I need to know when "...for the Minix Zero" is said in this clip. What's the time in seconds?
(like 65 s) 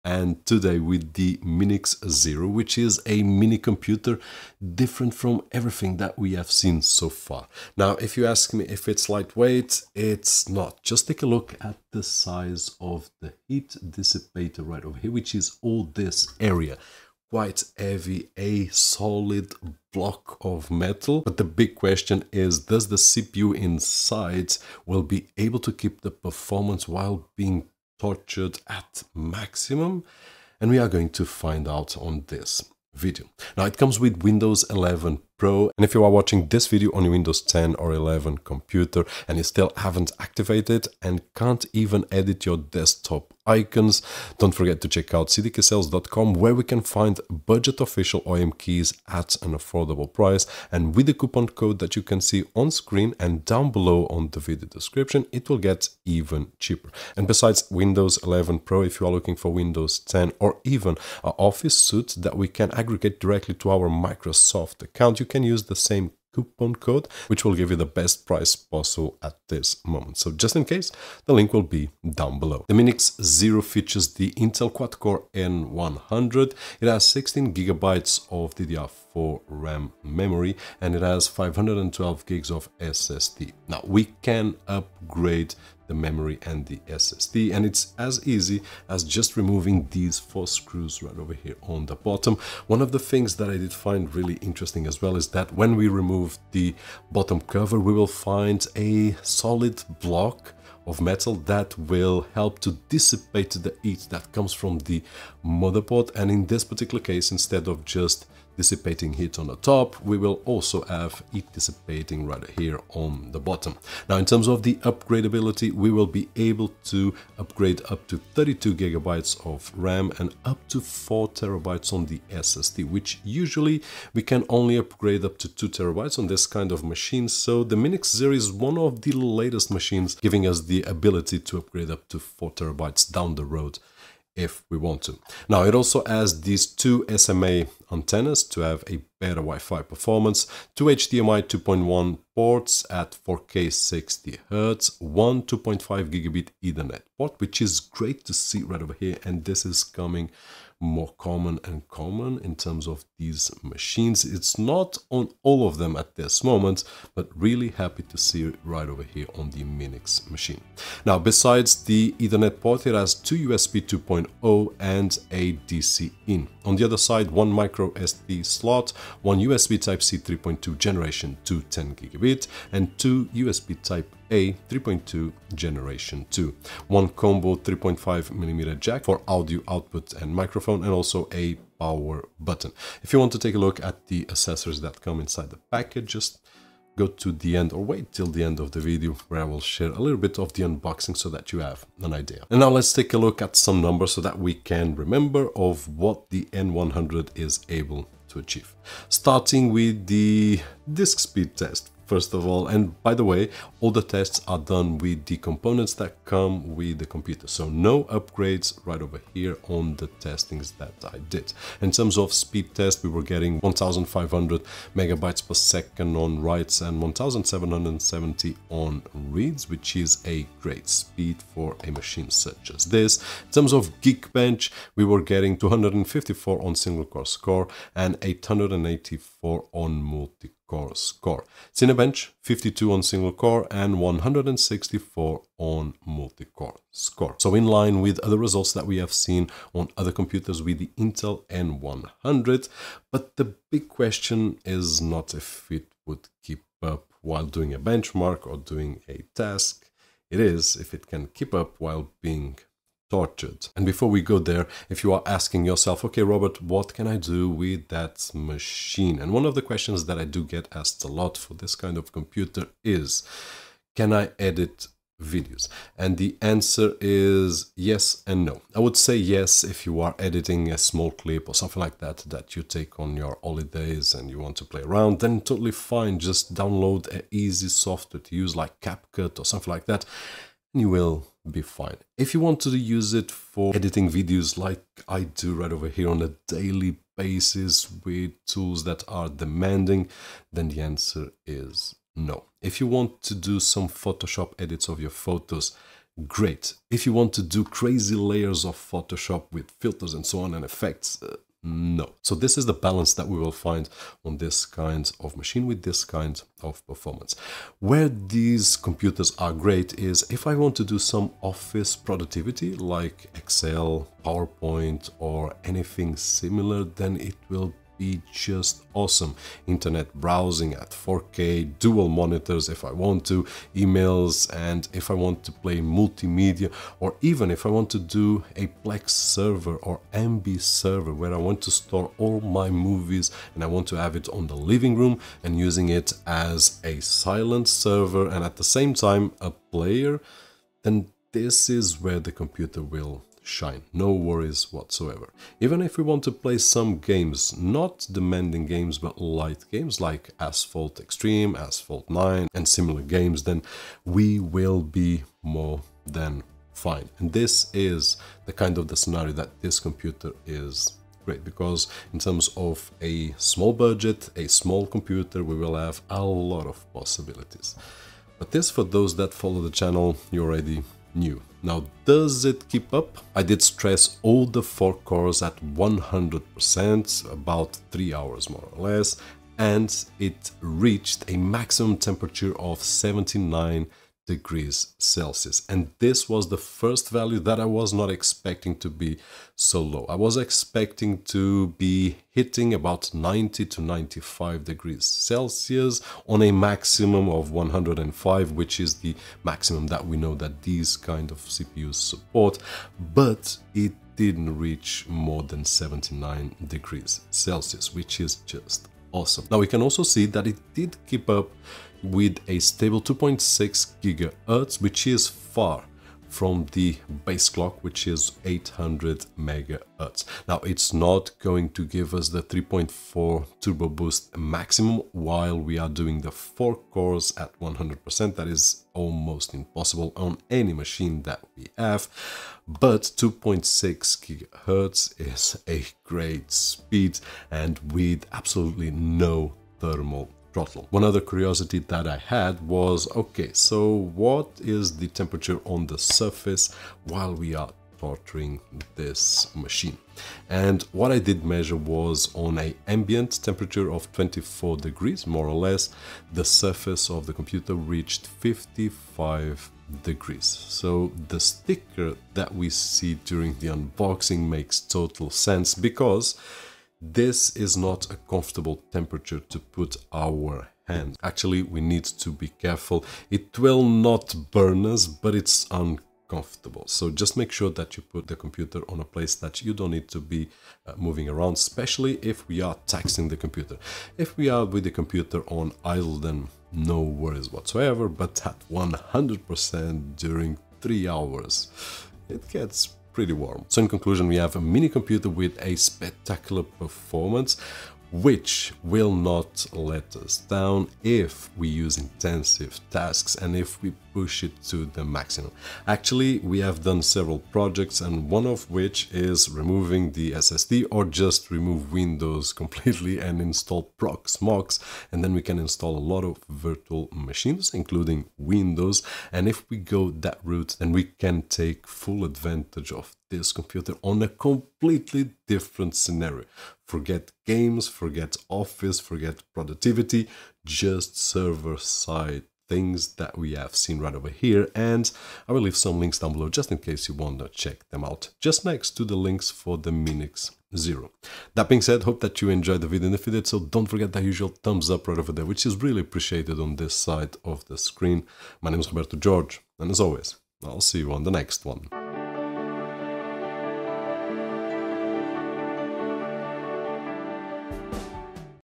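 539 s.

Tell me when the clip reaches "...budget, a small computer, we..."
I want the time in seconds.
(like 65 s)
363 s.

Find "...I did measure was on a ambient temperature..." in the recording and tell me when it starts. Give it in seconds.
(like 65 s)
451 s.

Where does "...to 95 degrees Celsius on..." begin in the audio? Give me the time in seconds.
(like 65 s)
393 s.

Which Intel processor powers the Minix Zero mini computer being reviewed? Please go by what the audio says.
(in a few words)
Intel Quad-Core N100.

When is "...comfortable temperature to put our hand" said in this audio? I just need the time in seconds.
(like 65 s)
468 s.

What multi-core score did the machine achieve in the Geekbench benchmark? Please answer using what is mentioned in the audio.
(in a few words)
884.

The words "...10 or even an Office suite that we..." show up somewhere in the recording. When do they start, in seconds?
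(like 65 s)
59 s.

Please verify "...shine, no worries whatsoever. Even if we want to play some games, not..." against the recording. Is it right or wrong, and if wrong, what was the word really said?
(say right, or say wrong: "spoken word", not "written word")
right.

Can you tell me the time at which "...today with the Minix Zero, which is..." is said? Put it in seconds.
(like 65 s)
0 s.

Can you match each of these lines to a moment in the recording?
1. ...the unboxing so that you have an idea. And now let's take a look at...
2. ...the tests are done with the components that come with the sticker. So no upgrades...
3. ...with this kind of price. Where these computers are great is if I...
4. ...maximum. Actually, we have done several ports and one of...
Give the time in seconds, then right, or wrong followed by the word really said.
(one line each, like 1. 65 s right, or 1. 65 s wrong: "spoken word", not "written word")
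1. 190 s right
2. 203 s wrong: "computer", not "sticker"
3. 305 s wrong: "performance", not "price"
4. 505 s wrong: "projects", not "ports".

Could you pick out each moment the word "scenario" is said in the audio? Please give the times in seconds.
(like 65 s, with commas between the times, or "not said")
358 s, 525 s.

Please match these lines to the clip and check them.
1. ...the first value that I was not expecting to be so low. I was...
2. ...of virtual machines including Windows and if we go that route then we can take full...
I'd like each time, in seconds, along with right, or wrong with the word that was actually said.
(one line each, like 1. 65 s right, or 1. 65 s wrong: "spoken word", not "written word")
1. 386 s right
2. 516 s right.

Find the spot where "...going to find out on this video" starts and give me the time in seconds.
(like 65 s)
30 s.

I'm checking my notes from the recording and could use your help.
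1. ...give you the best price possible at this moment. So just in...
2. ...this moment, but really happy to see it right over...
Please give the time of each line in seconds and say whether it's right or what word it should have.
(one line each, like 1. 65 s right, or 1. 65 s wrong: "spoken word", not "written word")
1. 67 s right
2. 156 s right.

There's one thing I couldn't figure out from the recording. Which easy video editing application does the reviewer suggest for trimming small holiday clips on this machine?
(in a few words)
CapCut.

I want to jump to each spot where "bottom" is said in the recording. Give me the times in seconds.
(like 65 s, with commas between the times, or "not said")
91 s, 97 s, 113 s.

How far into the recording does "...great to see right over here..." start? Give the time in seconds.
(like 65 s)
147 s.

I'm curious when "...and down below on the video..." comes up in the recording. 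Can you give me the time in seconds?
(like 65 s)
53 s.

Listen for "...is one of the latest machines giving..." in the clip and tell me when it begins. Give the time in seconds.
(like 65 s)
128 s.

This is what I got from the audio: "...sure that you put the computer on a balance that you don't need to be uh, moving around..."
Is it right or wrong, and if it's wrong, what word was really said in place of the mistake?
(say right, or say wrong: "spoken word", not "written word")
wrong: "place", not "balance".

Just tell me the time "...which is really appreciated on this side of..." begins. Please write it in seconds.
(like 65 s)
545 s.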